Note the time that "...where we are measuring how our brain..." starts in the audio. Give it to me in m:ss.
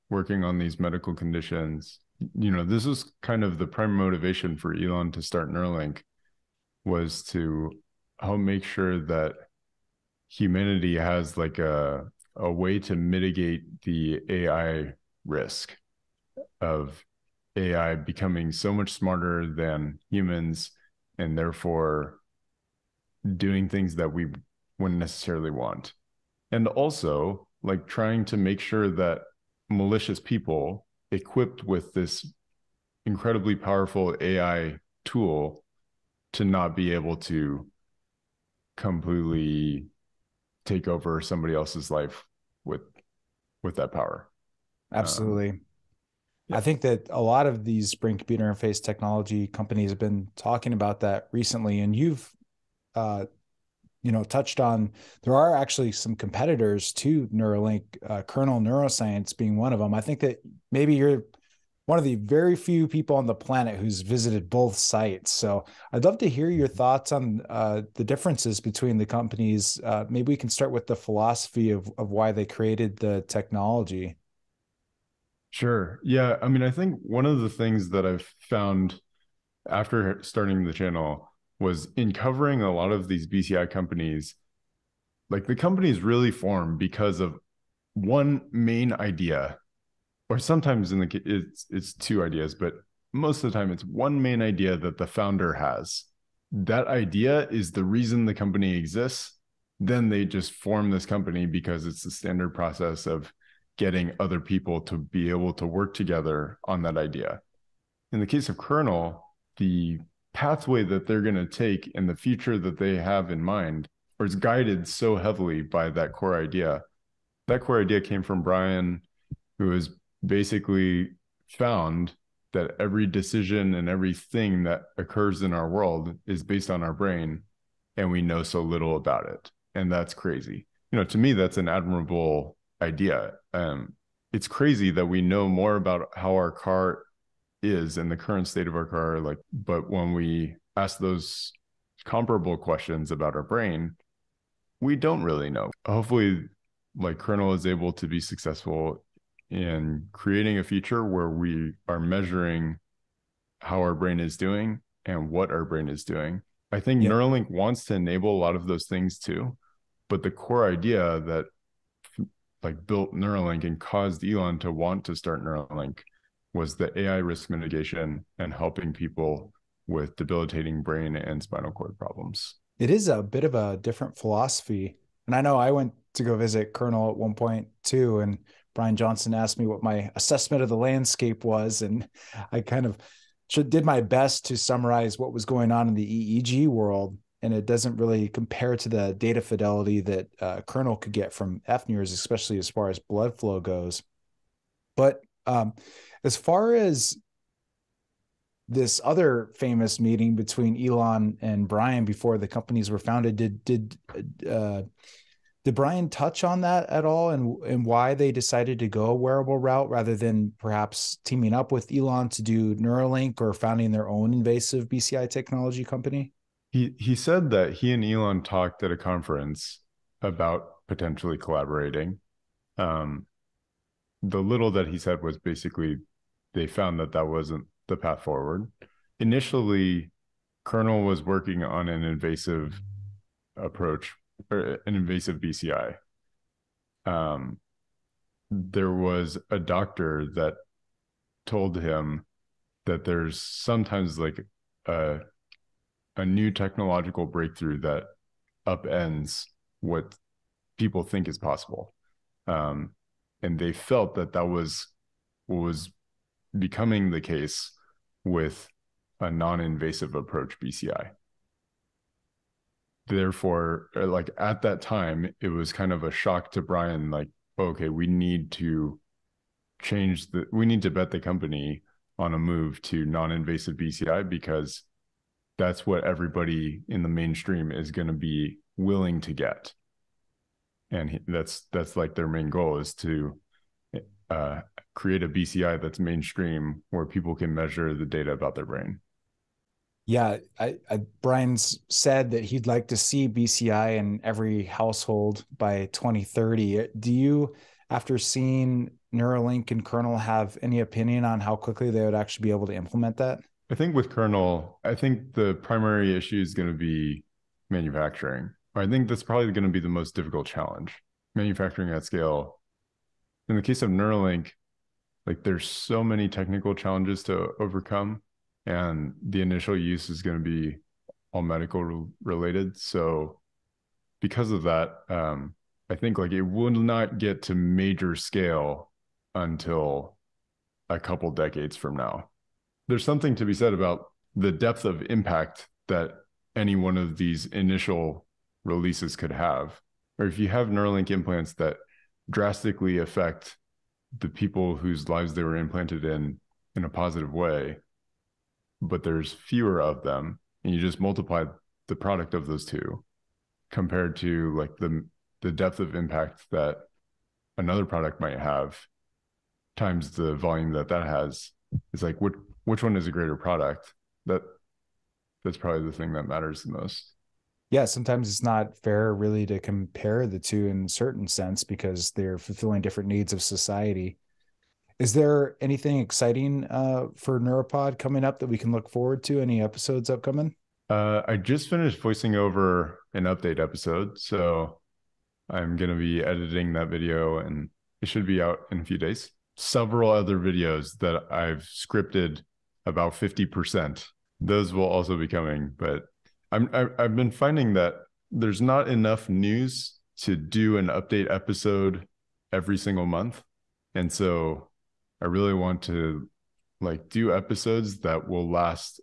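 2:31.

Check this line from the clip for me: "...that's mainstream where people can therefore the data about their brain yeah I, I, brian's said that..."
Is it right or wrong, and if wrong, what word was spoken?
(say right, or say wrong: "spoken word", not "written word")
wrong: "measure", not "therefore".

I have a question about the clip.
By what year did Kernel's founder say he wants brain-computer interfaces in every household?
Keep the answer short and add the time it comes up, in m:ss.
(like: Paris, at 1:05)
2030, at 4:55.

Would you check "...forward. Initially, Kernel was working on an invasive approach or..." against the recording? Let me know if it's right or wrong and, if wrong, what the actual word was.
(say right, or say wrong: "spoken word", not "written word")
right.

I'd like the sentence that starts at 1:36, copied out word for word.
That idea is the reason the company exists.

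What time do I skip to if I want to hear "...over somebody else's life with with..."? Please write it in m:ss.
0:40.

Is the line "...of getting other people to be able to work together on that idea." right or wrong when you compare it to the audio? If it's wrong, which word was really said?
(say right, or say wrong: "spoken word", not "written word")
right.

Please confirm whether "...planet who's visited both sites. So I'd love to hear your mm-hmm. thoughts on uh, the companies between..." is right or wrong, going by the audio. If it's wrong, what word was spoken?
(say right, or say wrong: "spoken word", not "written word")
wrong: "differences", not "companies".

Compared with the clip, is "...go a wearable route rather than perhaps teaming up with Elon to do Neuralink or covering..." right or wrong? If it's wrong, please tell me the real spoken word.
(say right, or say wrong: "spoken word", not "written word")
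wrong: "founding", not "covering".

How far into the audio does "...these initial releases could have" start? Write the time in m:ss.
5:37.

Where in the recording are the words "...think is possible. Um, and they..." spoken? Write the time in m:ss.
4:11.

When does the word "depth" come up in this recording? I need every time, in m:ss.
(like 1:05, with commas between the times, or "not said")
5:34, 5:55.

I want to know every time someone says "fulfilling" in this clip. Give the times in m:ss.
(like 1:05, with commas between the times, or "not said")
6:12.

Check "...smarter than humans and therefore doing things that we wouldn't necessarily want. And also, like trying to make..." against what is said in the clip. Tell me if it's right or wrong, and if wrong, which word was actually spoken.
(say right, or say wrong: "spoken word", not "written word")
right.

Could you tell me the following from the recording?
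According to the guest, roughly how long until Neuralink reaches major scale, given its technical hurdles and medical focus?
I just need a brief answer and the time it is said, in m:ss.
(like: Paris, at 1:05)
A couple decades, at 5:30.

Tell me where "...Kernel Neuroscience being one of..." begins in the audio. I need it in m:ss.
0:58.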